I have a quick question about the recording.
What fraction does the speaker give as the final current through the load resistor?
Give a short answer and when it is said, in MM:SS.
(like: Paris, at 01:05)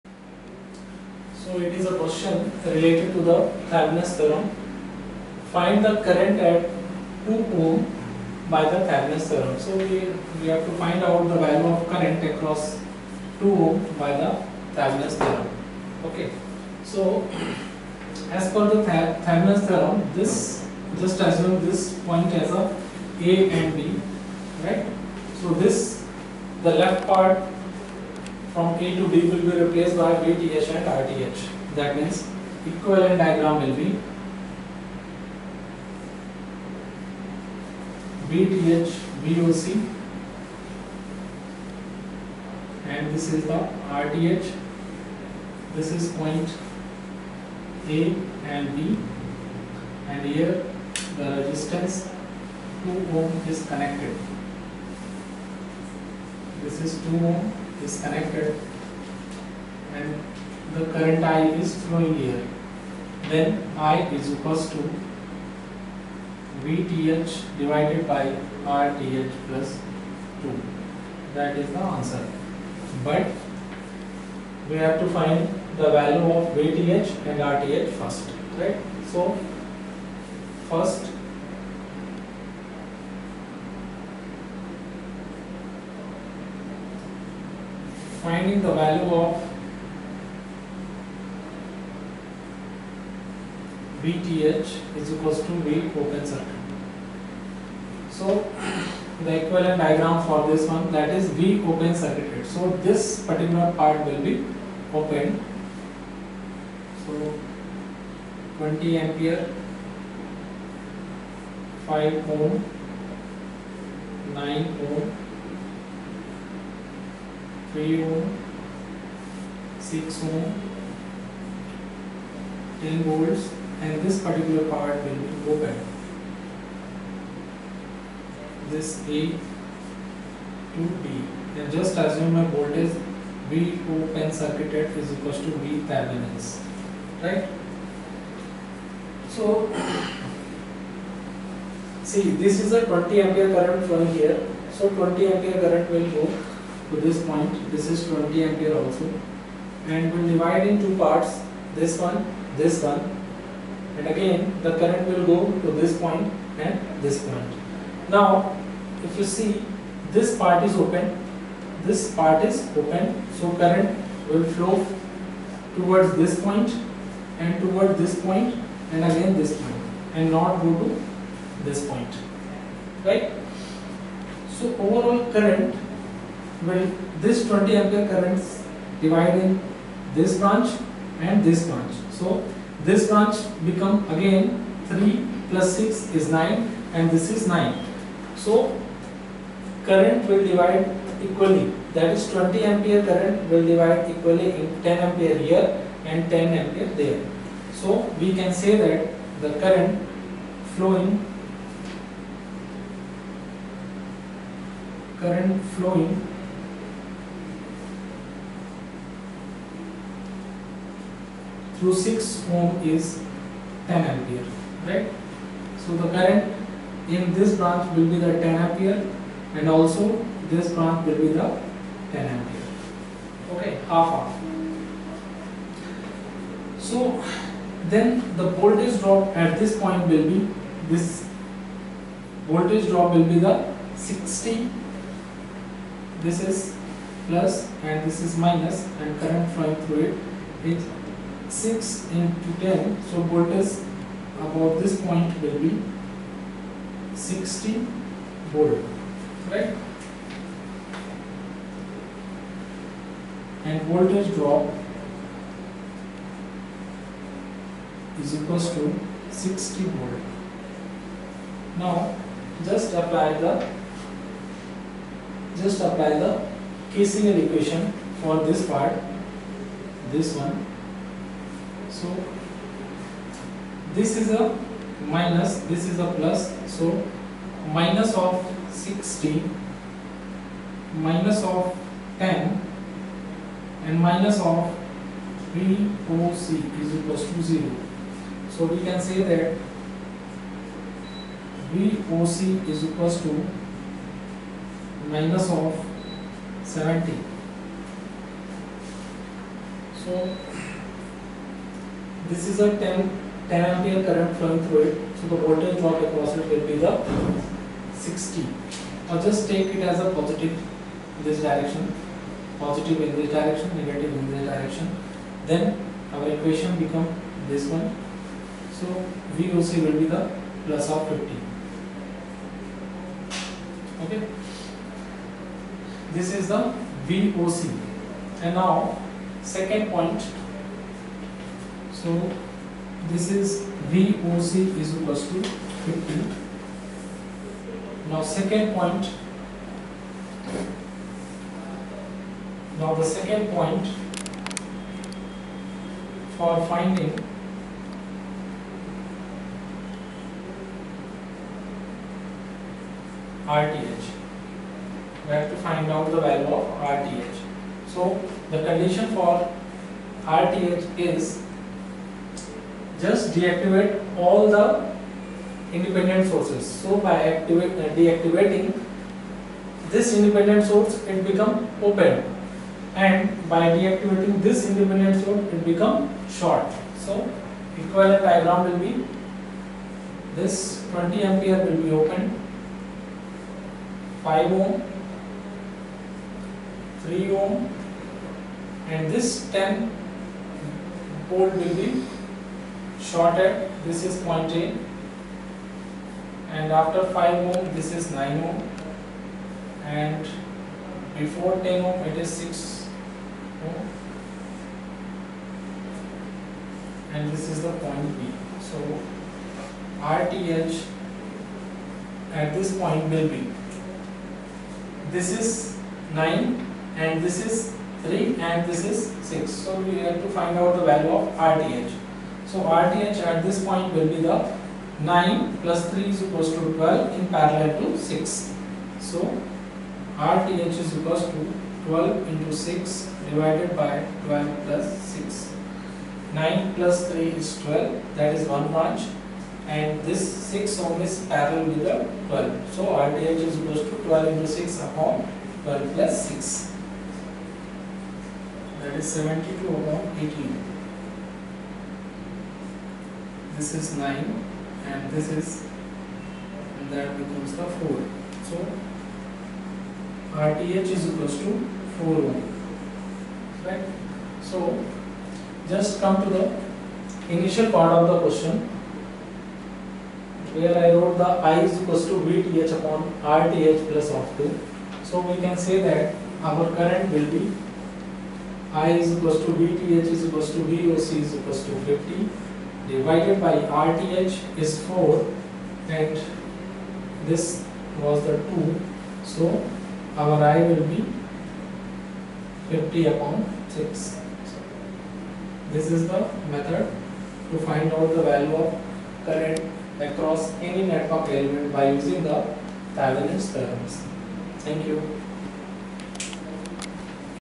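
50/6, at 08:12.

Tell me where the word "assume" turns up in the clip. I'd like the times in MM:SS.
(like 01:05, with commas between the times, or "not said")
00:21, 02:11.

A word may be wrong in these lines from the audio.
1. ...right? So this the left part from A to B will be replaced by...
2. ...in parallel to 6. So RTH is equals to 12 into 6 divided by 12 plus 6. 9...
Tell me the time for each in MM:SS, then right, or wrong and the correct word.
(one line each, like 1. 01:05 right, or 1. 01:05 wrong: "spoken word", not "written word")
1. 00:24 right
2. 07:07 right.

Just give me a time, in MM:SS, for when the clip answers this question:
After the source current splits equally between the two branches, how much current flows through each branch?
03:14.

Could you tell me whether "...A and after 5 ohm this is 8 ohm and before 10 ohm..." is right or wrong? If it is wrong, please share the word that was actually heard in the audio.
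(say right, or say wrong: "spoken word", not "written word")
wrong: "9", not "8".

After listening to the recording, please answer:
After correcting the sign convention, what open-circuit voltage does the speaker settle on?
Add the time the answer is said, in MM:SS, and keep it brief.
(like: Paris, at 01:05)
50, at 05:20.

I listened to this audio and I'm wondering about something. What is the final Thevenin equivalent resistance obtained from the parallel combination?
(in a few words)
4 ohms.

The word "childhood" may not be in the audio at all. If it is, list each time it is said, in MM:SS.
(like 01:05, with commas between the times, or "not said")
not said.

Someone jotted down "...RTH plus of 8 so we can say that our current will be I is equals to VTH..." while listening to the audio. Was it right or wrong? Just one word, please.
wrong.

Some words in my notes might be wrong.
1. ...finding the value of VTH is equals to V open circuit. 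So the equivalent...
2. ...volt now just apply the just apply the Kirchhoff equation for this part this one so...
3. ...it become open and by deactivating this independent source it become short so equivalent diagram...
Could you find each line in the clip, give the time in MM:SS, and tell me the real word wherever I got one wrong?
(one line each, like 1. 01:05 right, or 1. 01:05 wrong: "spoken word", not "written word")
1. 01:28 right
2. 04:19 right
3. 06:11 right.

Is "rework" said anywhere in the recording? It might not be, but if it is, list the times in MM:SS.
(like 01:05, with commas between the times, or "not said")
not said.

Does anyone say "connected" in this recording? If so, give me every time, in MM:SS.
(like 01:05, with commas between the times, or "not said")
00:53, 00:58.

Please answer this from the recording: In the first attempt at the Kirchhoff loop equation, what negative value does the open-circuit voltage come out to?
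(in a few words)
-70.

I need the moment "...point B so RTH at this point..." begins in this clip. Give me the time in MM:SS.
06:47.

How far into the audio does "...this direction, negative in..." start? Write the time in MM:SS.
05:13.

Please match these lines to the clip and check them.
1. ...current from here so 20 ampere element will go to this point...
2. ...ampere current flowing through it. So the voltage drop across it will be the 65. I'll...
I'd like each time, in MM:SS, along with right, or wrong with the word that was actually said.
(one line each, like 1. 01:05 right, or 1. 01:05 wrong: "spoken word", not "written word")
1. 02:23 wrong: "current", not "element"
2. 05:03 wrong: "60", not "65".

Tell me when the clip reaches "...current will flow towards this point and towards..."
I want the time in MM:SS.
02:43.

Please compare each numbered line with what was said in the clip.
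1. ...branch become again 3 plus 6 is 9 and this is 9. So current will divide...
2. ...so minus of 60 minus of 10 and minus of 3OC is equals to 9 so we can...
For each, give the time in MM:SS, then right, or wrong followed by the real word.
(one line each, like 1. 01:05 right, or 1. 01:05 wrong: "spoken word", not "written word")
1. 03:03 right
2. 04:36 wrong: "0", not "9".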